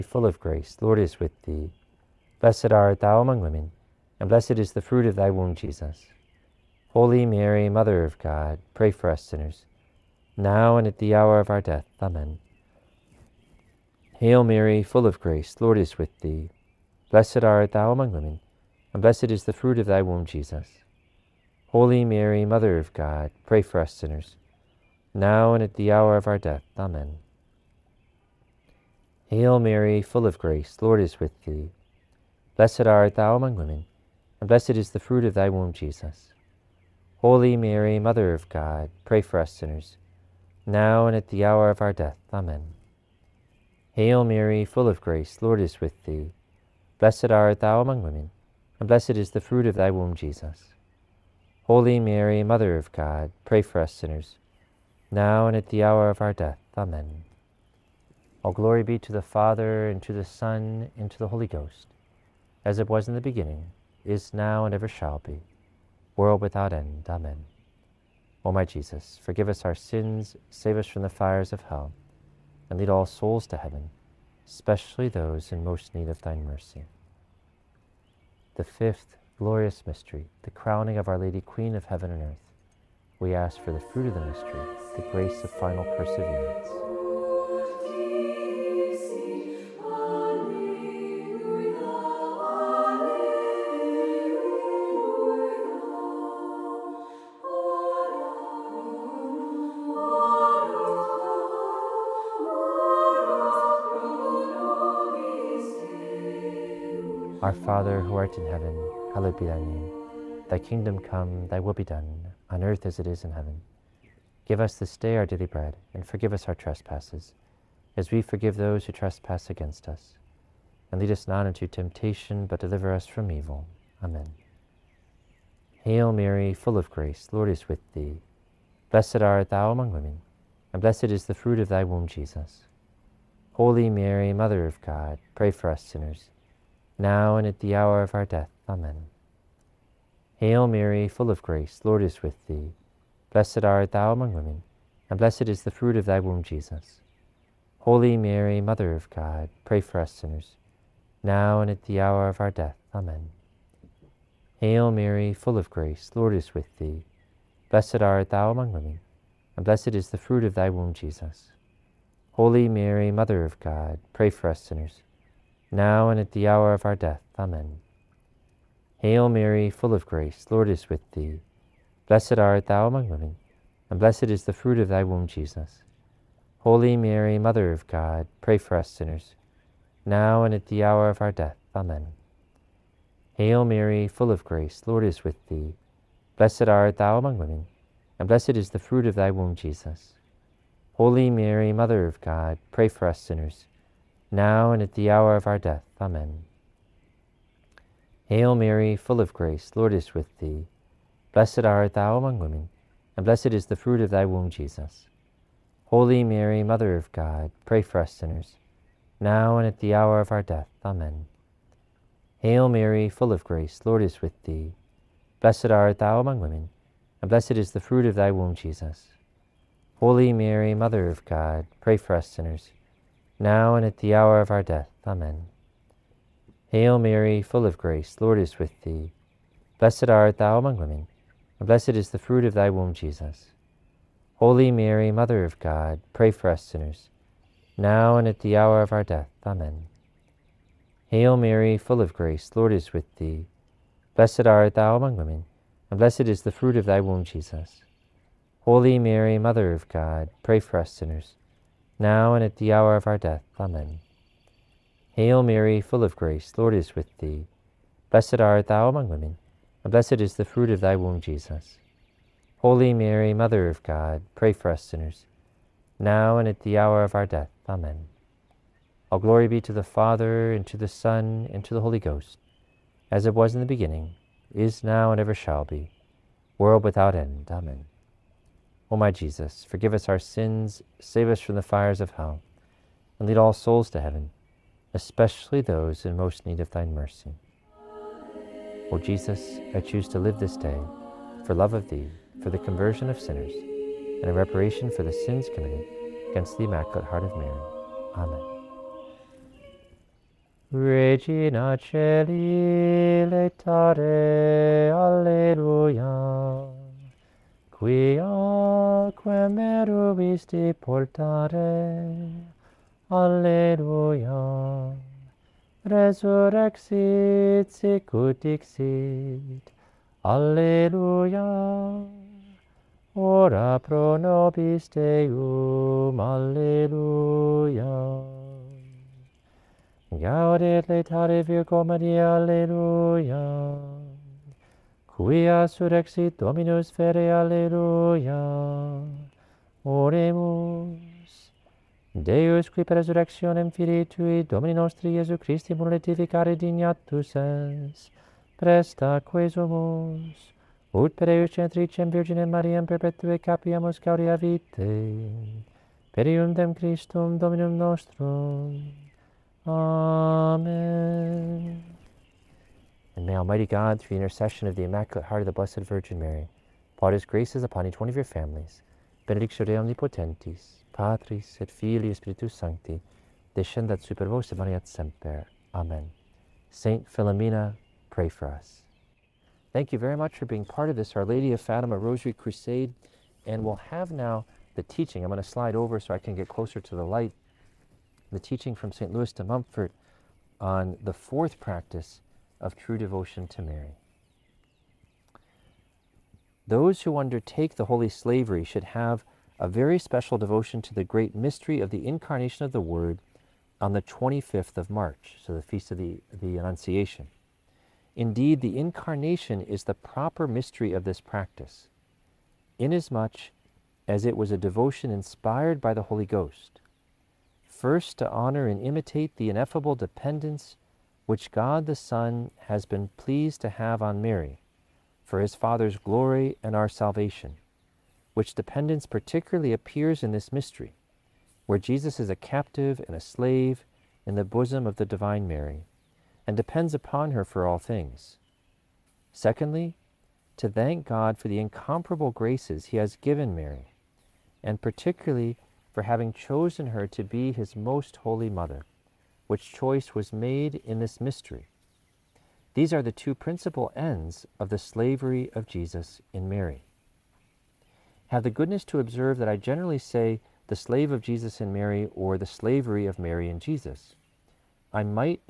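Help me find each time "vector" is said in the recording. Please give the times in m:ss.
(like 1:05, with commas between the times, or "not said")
not said.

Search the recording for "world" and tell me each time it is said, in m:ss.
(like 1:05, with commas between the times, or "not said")
1:06, 4:36.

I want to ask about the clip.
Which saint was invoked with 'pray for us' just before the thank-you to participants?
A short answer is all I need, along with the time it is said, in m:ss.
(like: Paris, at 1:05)
Saint Philomena, at 6:16.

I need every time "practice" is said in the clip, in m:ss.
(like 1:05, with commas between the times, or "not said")
6:31, 6:51.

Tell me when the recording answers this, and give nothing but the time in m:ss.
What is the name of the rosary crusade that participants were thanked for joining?
6:21.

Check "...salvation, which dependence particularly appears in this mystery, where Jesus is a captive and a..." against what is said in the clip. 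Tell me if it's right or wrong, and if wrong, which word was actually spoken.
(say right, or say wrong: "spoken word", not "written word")
right.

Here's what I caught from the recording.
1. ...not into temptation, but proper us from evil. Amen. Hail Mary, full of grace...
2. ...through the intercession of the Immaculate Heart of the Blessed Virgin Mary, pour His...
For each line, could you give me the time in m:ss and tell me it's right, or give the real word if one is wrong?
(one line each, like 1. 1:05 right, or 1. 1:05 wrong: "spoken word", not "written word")
1. 2:01 wrong: "deliver", not "proper"
2. 6:03 right.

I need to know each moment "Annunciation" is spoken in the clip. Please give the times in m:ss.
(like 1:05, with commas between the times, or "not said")
6:46.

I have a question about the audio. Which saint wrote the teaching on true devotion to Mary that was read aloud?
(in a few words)
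St. Louis de Montfort.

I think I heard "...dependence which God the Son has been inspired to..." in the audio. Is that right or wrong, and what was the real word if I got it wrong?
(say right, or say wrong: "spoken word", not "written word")
wrong: "pleased", not "inspired".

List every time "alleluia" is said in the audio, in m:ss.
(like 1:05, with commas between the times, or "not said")
5:04, 5:13, 5:20, 5:26, 5:32, 5:37.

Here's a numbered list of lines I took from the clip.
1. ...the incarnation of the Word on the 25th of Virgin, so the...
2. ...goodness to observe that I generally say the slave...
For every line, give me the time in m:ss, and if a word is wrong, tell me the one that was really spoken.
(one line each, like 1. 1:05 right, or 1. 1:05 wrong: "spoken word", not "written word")
1. 6:41 wrong: "March", not "Virgin"
2. 7:38 right.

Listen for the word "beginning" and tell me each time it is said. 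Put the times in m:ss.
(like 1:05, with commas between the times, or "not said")
1:03, 4:33.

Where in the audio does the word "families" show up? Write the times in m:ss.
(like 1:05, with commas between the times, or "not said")
6:08.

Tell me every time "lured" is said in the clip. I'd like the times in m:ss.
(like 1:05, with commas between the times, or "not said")
not said.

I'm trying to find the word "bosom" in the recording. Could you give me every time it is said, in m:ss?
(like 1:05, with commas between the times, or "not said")
7:14.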